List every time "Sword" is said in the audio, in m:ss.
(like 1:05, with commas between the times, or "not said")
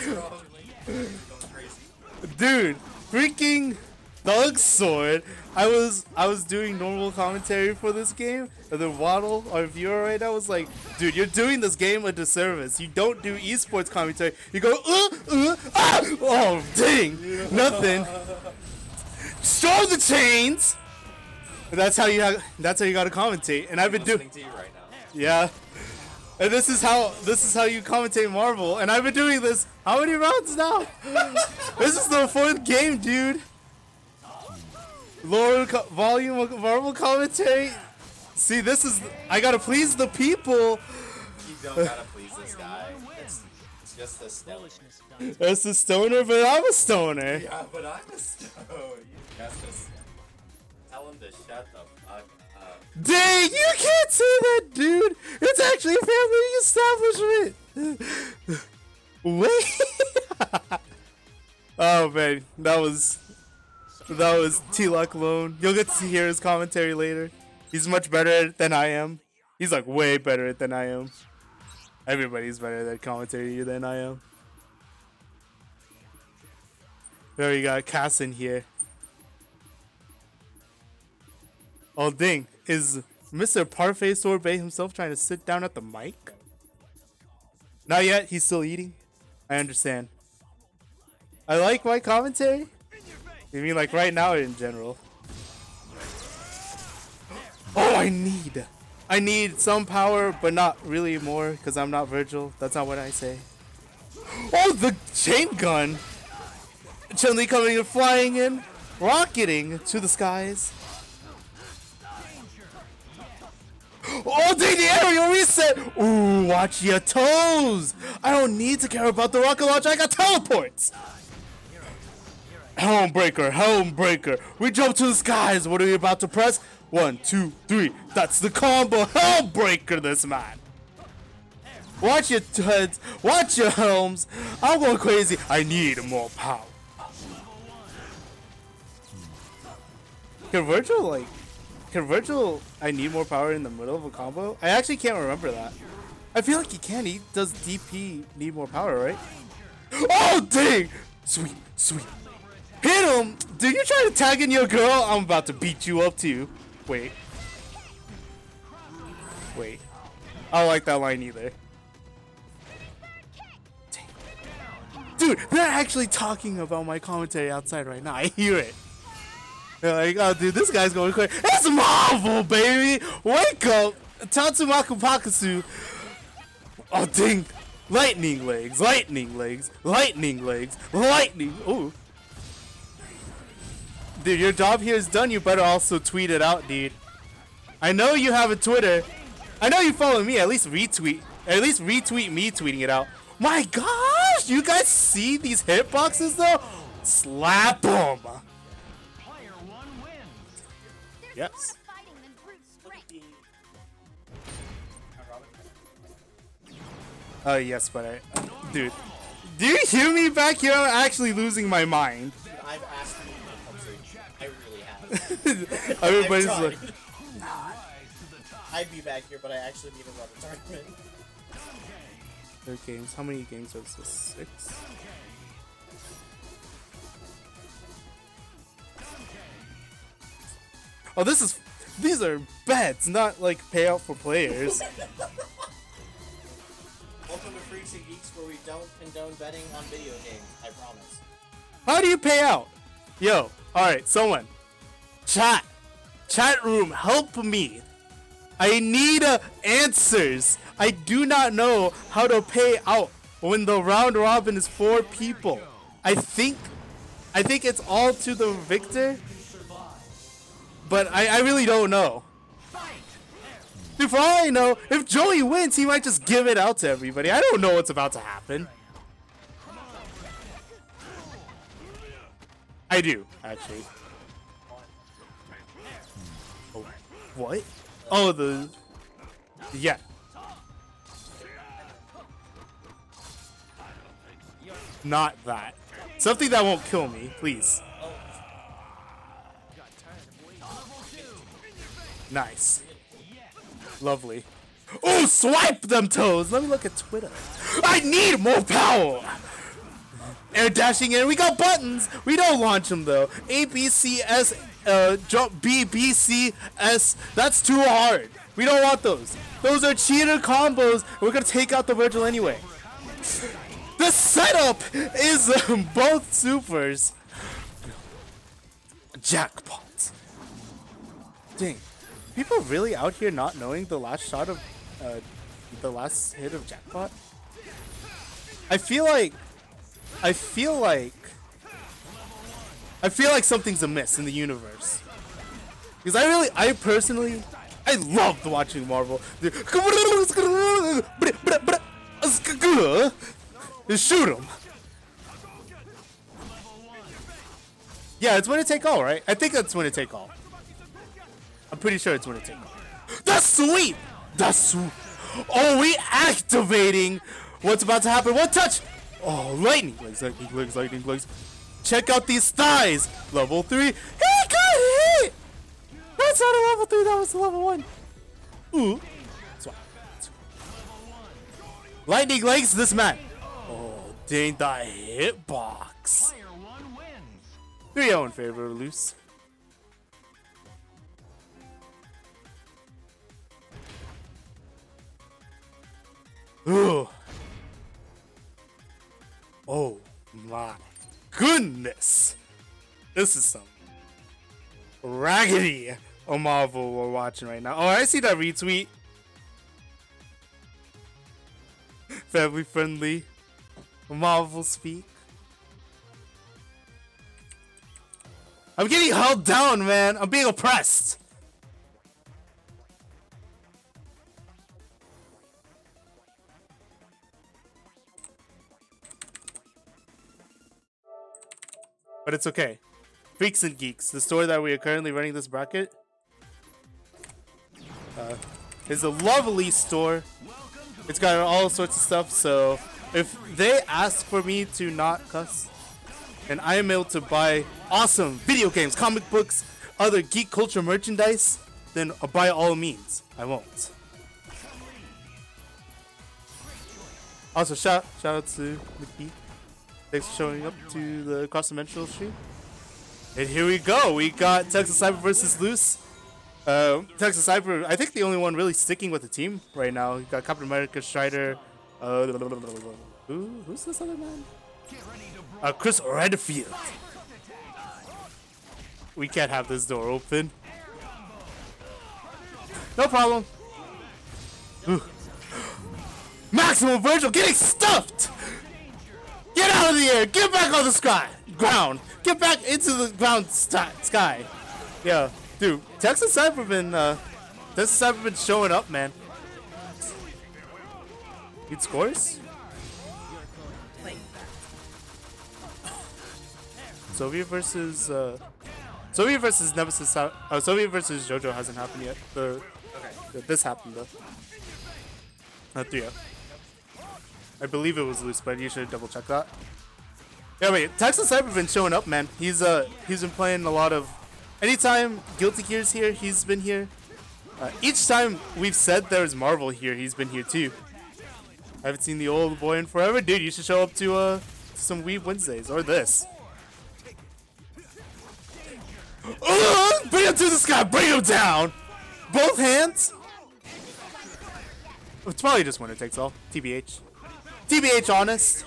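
0:04.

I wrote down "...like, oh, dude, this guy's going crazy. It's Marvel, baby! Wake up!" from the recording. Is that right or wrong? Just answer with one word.
right.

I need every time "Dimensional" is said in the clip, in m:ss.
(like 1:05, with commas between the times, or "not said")
7:31.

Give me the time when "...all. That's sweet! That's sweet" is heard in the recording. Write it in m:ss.
5:52.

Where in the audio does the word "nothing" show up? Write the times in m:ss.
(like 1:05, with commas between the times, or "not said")
0:17.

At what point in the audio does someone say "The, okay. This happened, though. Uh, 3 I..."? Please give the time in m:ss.
8:22.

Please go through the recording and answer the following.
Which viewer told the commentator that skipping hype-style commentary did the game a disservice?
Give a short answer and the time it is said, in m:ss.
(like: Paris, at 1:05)
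Waddle, at 0:08.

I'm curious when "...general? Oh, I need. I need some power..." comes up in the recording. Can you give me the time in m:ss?
1:34.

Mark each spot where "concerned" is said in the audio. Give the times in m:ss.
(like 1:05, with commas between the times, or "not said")
not said.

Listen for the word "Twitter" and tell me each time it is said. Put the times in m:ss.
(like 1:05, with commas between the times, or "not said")
3:08, 4:56.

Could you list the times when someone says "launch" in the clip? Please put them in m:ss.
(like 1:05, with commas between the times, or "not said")
1:59, 5:02.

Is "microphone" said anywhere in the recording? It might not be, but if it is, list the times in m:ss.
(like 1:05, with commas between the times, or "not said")
not said.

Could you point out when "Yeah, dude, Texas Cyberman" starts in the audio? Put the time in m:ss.
8:05.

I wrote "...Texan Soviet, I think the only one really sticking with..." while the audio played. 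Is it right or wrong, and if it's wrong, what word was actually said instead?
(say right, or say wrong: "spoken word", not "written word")
wrong: "Sniper", not "Soviet".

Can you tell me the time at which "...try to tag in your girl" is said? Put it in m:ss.
2:33.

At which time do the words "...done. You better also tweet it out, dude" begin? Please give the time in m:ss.
3:05.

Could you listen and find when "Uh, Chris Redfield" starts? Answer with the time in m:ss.
7:45.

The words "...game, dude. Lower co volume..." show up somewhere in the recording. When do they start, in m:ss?
0:32.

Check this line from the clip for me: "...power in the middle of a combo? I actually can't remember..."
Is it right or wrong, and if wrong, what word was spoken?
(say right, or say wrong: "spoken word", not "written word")
right.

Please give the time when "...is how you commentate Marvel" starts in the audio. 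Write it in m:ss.
0:27.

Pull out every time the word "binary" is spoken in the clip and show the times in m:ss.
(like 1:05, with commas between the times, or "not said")
not said.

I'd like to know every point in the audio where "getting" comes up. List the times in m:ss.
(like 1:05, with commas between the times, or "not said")
6:48, 7:57.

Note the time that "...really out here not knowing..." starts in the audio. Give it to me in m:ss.
5:22.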